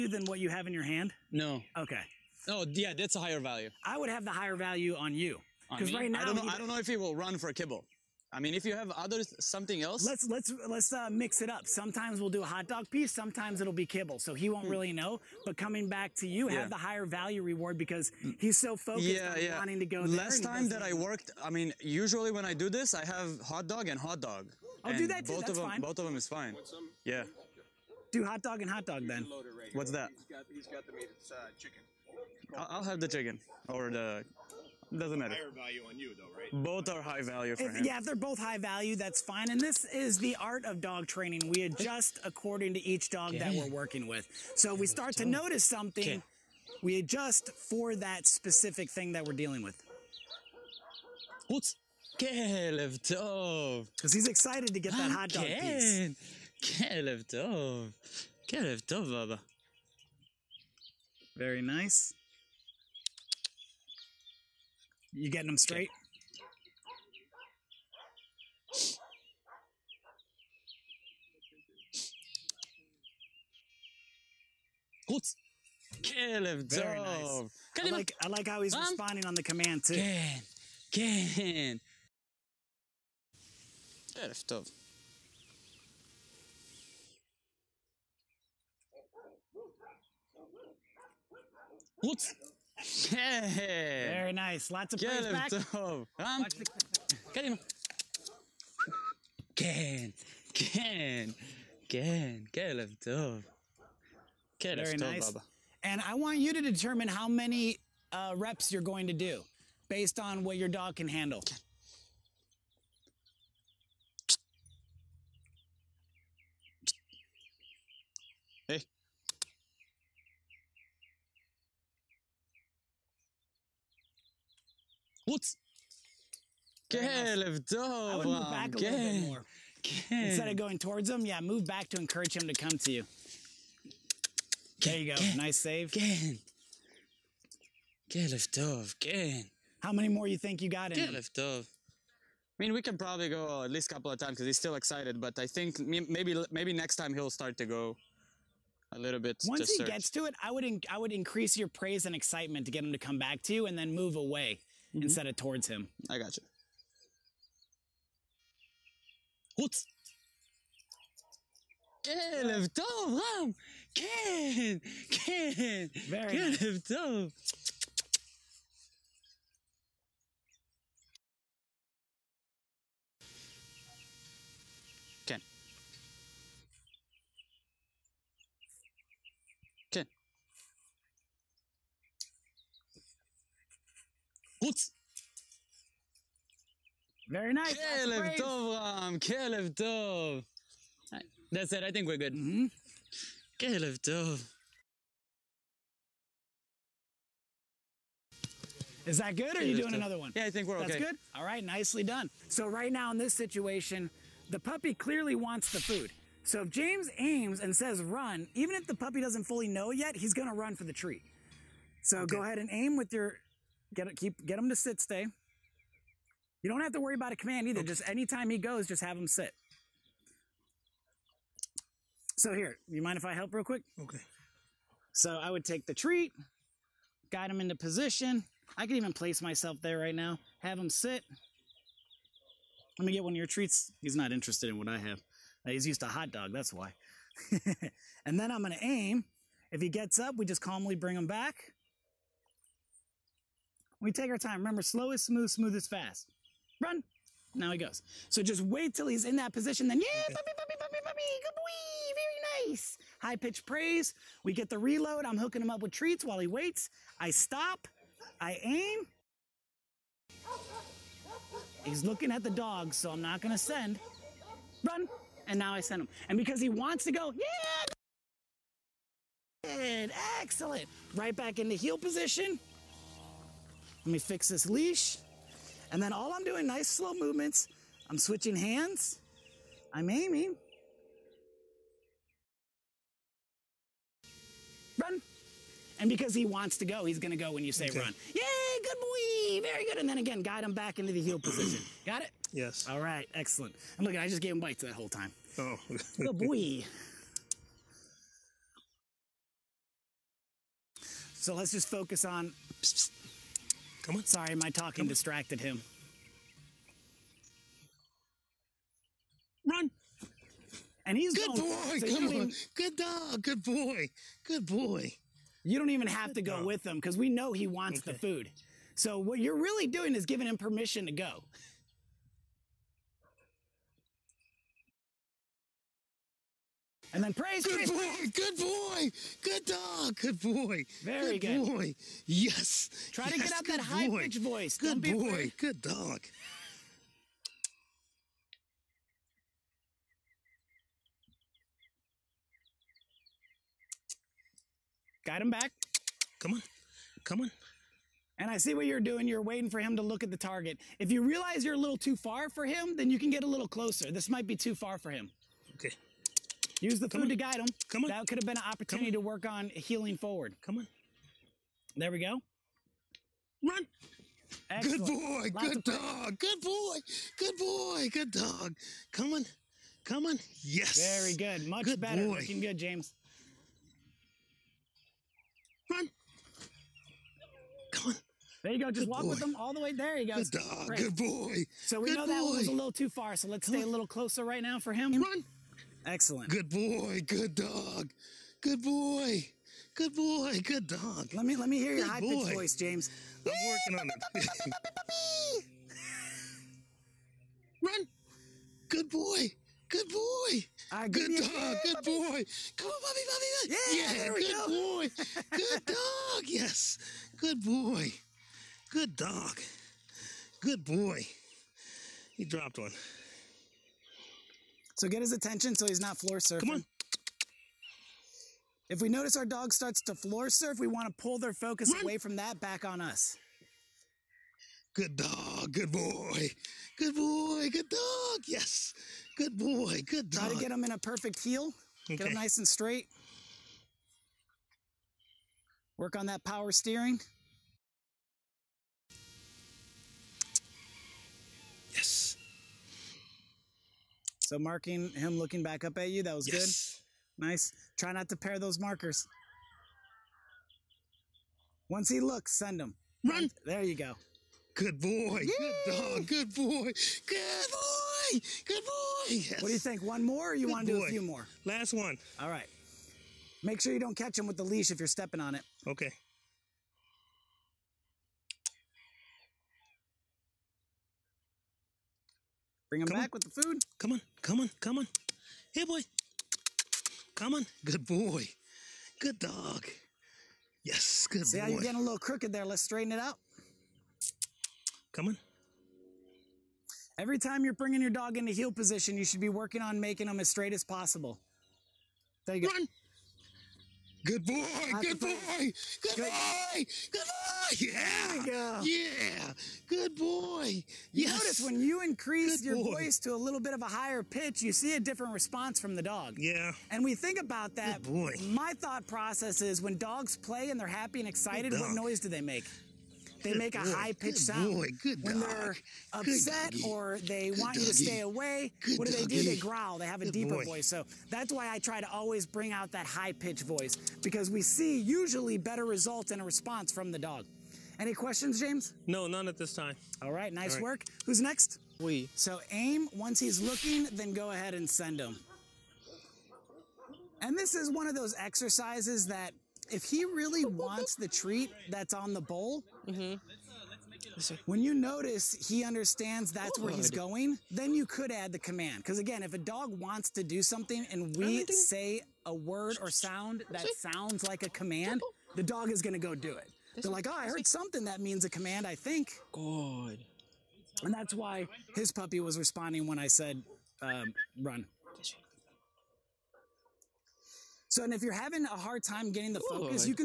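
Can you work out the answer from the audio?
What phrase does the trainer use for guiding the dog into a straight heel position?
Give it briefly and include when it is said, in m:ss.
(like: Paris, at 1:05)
power steering, at 7:16.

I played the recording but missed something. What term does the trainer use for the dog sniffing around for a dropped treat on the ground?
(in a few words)
floor surfing.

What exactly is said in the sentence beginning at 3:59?
If he gets up, we just calmly bring him back.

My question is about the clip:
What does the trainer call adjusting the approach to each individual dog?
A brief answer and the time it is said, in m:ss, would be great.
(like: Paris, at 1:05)
the art of dog training, at 0:40.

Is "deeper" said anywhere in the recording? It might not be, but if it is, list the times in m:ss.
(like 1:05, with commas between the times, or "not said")
8:40.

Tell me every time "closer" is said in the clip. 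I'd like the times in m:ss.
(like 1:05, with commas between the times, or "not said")
5:53, 6:24.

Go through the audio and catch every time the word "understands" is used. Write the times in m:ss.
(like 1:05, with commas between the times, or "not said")
9:05.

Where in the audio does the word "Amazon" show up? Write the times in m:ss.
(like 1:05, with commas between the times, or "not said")
not said.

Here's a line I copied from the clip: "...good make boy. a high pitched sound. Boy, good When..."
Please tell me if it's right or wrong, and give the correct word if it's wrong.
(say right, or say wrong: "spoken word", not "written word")
right.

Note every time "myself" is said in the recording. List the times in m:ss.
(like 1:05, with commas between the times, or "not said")
3:49.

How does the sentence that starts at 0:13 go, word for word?
Sometimes it'll be kibble, so he won't mm.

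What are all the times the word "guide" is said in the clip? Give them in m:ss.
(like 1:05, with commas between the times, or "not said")
3:47, 4:50, 5:57.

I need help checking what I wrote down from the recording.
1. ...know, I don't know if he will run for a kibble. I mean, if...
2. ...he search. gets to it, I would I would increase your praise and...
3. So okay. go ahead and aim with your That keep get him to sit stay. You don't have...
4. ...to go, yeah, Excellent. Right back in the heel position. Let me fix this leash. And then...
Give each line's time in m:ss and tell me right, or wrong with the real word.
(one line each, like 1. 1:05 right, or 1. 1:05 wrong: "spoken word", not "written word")
1. 0:06 right
2. 2:29 right
3. 3:32 wrong: "Get", not "That"
4. 4:27 right.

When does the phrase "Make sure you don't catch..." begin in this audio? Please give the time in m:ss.
7:43.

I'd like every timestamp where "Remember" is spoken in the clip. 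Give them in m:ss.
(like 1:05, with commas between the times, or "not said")
4:04.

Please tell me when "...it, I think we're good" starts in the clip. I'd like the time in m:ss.
3:11.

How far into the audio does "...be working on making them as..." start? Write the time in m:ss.
8:09.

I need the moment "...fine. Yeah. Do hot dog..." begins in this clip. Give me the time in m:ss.
0:26.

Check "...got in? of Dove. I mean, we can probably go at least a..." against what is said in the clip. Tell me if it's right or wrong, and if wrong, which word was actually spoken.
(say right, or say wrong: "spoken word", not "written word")
right.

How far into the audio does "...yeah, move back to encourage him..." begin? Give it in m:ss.
2:11.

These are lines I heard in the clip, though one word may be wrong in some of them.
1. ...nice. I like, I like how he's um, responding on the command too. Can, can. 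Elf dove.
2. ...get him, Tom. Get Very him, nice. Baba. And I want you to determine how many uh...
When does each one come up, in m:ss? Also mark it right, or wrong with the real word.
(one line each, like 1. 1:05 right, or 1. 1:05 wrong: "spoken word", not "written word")
1. 1:16 right
2. 1:42 right.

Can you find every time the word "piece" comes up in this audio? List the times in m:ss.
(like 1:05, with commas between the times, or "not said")
0:12, 0:55.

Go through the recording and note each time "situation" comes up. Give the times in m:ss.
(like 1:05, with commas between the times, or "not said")
3:23.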